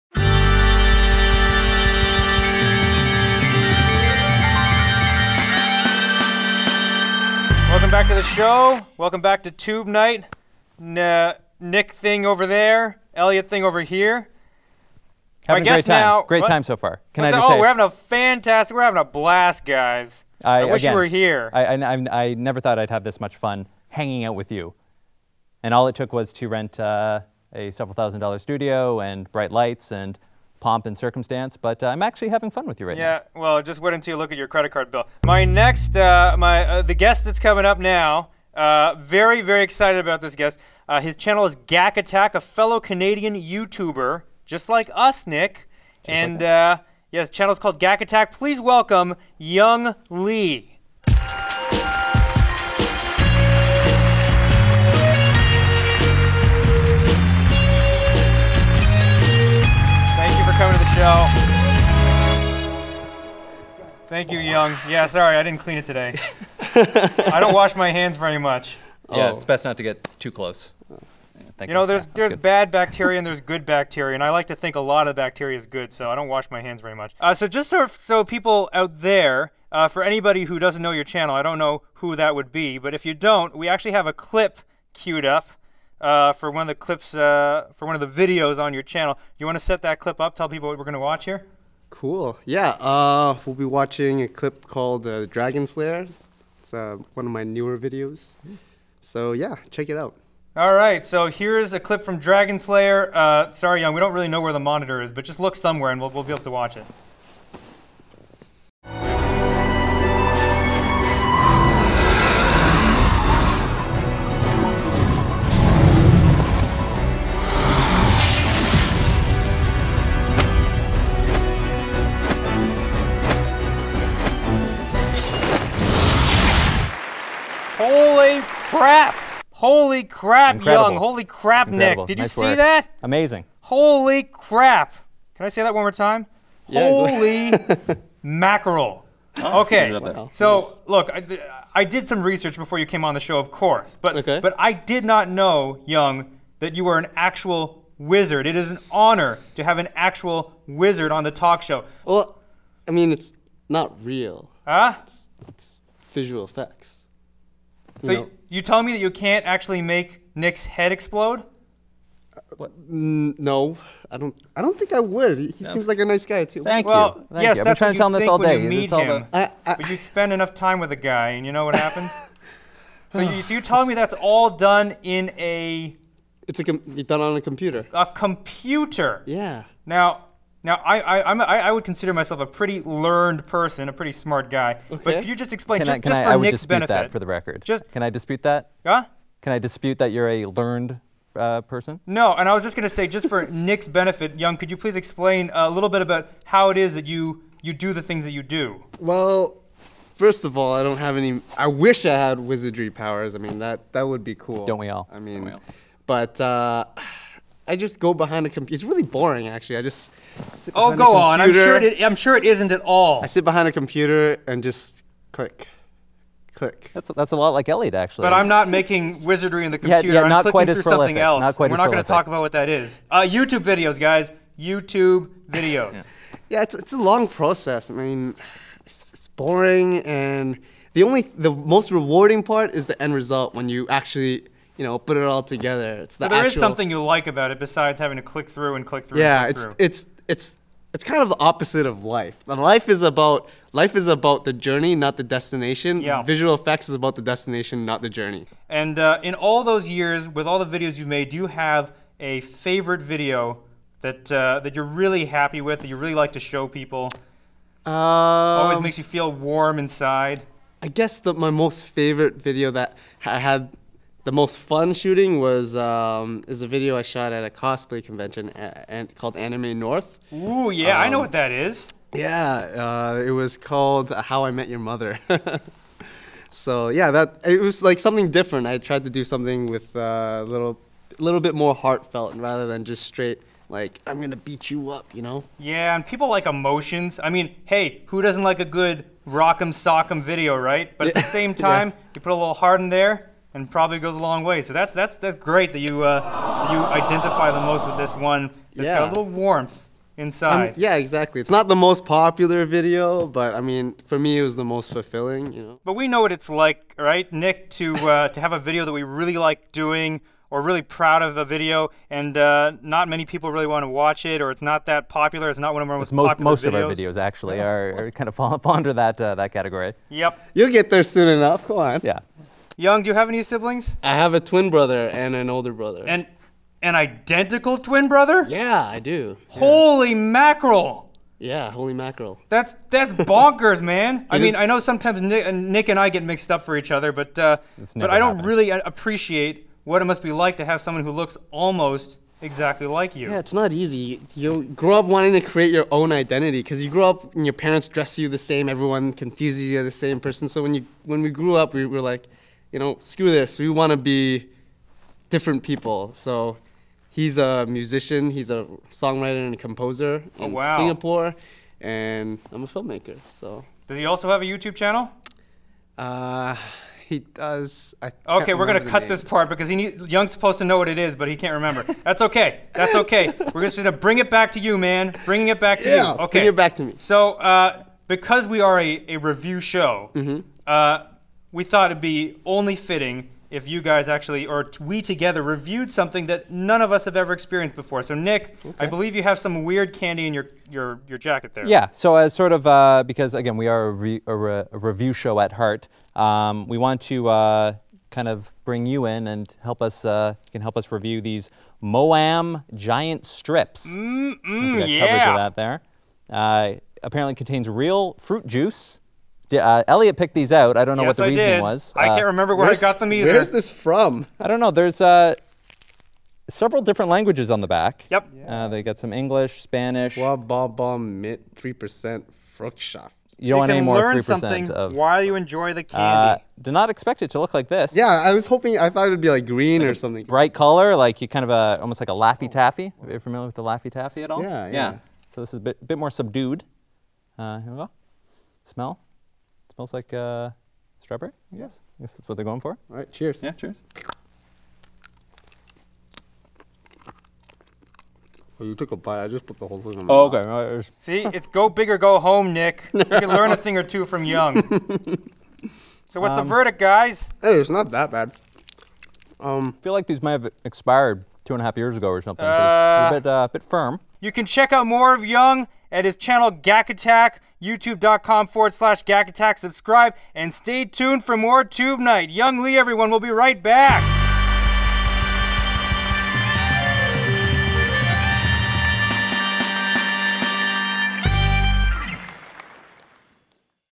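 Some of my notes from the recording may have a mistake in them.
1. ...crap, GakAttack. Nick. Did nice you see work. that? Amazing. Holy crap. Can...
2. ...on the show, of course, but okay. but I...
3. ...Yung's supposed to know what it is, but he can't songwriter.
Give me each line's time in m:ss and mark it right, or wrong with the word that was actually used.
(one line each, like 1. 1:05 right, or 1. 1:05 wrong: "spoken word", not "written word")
1. 2:11 wrong: "Incredible", not "GakAttack"
2. 2:23 right
3. 6:10 wrong: "remember", not "songwriter".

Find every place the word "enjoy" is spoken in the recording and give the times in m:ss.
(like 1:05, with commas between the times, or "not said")
7:05.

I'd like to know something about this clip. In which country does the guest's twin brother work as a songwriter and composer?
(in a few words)
Singapore.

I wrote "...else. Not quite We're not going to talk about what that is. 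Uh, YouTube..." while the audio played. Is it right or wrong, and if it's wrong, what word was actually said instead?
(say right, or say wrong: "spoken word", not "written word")
right.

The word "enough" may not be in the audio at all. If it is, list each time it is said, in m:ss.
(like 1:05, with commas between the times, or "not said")
2:50, 5:21.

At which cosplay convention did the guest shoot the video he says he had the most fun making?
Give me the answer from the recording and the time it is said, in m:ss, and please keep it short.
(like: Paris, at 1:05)
Anime North, at 4:29.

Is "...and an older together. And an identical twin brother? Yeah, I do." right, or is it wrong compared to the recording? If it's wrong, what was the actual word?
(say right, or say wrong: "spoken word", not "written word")
wrong: "brother", not "together".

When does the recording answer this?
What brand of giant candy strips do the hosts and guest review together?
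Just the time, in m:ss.
6:41.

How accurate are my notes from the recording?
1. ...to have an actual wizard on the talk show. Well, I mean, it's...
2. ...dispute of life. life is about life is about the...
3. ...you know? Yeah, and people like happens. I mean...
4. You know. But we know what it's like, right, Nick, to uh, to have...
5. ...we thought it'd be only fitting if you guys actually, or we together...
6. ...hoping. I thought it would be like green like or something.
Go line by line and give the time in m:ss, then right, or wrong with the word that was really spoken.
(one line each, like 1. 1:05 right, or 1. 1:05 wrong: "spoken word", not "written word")
1. 2:29 right
2. 4:01 wrong: "opposite", not "dispute"
3. 4:45 wrong: "emotions", not "happens"
4. 5:05 right
5. 6:21 right
6. 7:08 right.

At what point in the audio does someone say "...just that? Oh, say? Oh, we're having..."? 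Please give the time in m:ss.
0:17.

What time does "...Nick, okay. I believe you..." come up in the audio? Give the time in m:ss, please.
6:28.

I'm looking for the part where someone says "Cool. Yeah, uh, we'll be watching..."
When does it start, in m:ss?
1:31.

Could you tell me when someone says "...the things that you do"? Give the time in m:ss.
3:17.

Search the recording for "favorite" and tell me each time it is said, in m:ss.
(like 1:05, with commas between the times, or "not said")
4:12, 4:21.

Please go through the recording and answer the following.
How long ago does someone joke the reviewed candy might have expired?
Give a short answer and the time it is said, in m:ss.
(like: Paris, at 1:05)
2 and a half years, at 7:41.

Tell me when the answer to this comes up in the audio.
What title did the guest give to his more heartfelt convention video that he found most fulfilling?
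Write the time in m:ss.
4:34.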